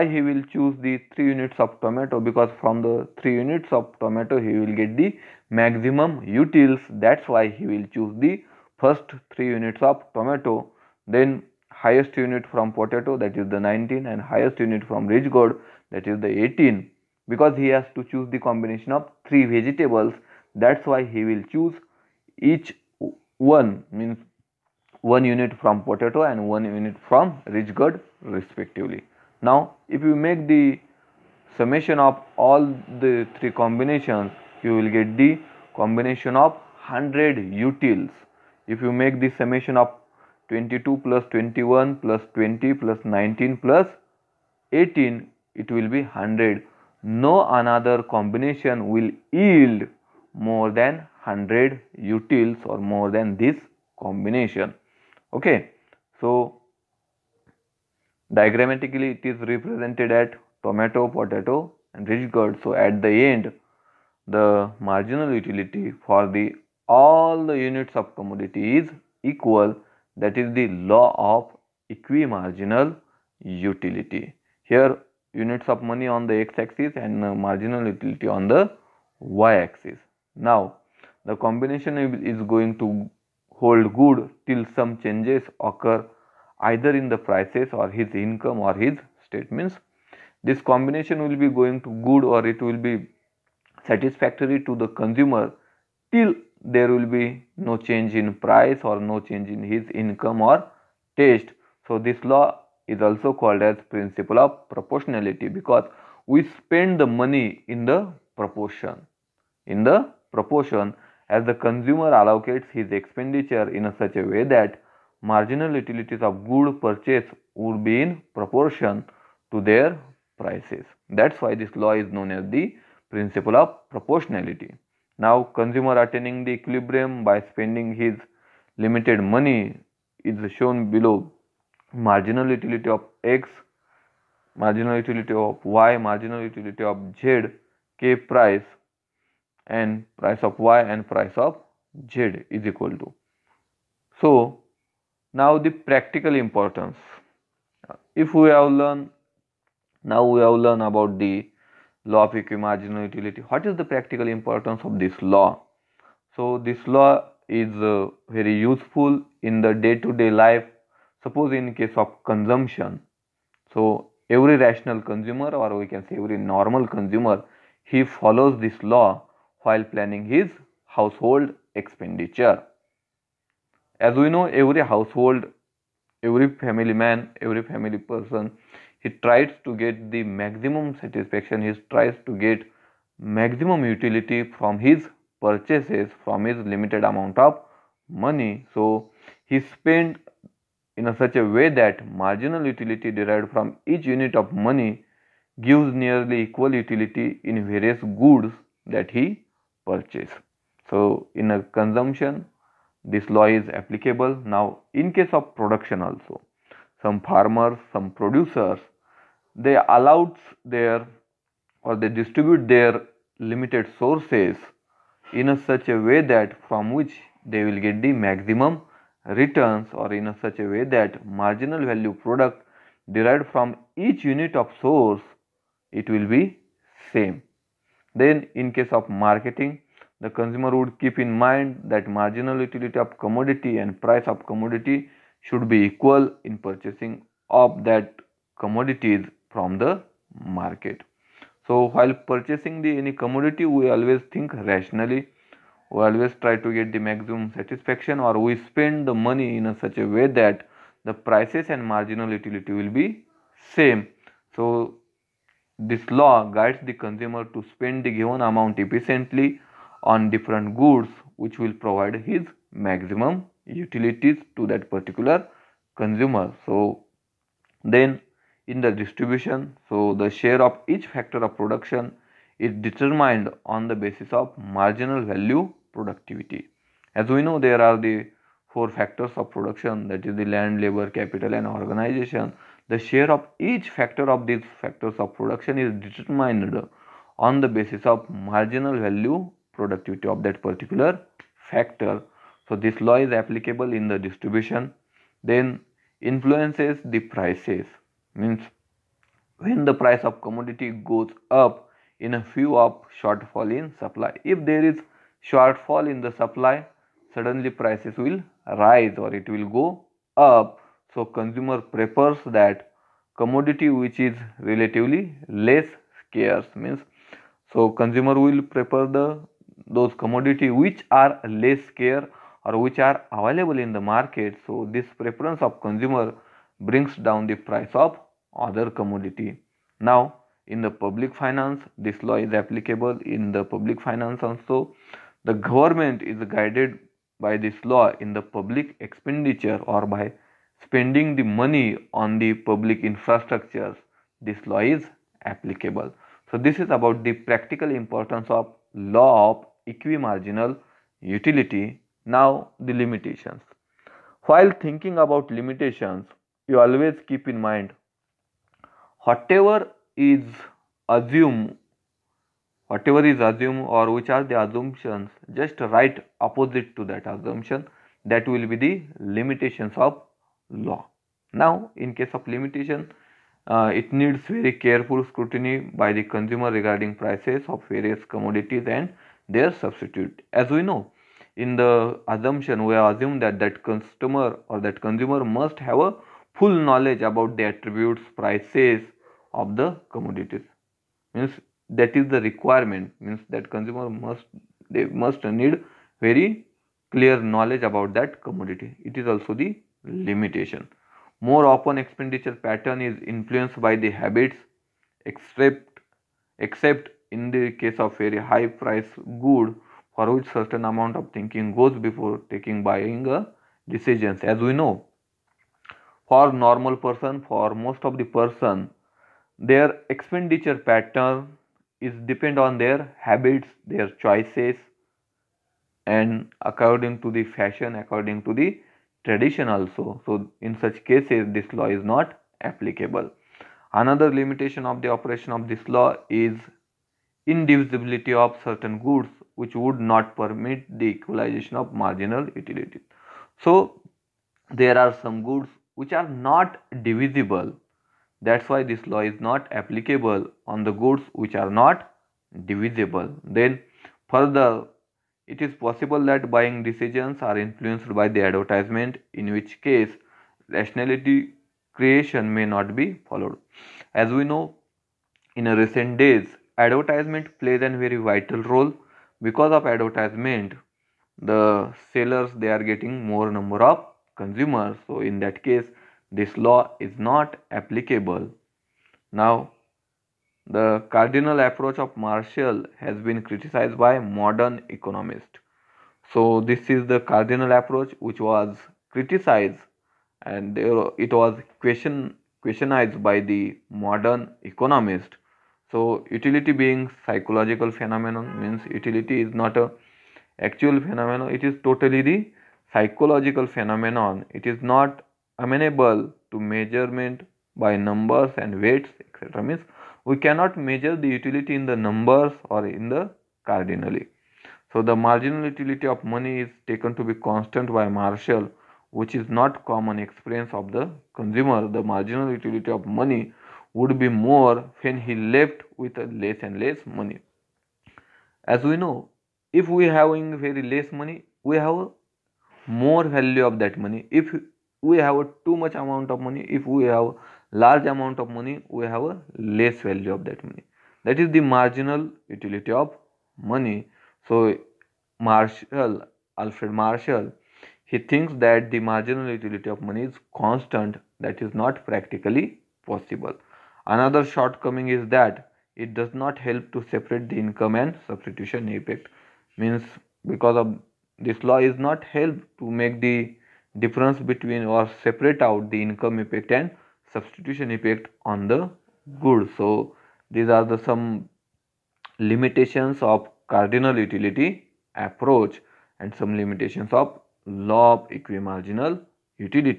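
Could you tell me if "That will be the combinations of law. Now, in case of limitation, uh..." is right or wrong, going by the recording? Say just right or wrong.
wrong.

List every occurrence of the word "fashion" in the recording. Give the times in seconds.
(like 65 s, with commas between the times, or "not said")
427 s.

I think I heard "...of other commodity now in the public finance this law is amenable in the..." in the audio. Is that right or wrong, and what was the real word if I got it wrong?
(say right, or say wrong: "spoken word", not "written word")
wrong: "applicable", not "amenable".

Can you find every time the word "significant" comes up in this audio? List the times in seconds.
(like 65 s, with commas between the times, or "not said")
not said.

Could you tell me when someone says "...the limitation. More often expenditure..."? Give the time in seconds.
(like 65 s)
399 s.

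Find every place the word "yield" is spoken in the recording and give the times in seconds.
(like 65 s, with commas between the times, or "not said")
49 s.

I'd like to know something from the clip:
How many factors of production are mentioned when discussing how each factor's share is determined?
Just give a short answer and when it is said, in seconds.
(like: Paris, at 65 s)
4, at 278 s.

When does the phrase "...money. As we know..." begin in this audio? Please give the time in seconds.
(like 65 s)
527 s.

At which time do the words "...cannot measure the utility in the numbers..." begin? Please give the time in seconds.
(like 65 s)
510 s.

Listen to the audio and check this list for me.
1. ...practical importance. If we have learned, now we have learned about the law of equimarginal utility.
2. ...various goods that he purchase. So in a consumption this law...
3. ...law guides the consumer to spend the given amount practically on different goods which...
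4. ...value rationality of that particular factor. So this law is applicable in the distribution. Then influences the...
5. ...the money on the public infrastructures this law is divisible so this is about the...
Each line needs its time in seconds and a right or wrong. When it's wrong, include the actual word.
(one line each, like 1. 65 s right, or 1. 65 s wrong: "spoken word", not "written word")
1. 145 s right
2. 197 s right
3. 256 s wrong: "efficiently", not "practically"
4. 288 s wrong: "productivity", not "rationality"
5. 341 s wrong: "applicable", not "divisible".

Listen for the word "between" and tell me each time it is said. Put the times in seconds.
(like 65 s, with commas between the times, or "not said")
564 s.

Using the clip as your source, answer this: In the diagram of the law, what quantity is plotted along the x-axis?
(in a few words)
Units of money.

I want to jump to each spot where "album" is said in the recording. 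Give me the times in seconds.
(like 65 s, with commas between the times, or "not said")
not said.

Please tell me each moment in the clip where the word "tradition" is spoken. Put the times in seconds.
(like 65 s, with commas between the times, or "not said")
429 s.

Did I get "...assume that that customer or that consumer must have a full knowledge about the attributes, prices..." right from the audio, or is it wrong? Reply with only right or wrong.
right.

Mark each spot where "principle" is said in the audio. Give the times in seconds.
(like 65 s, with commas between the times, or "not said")
103 s, 123 s.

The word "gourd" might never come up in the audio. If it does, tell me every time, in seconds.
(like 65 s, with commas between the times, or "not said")
15 s, 27 s, 62 s.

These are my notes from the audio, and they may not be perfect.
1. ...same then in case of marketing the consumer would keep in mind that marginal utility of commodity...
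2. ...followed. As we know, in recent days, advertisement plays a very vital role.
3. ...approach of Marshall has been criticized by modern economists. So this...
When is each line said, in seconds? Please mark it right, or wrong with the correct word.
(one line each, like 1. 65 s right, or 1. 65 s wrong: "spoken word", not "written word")
1. 227 s right
2. 463 s right
3. 481 s right.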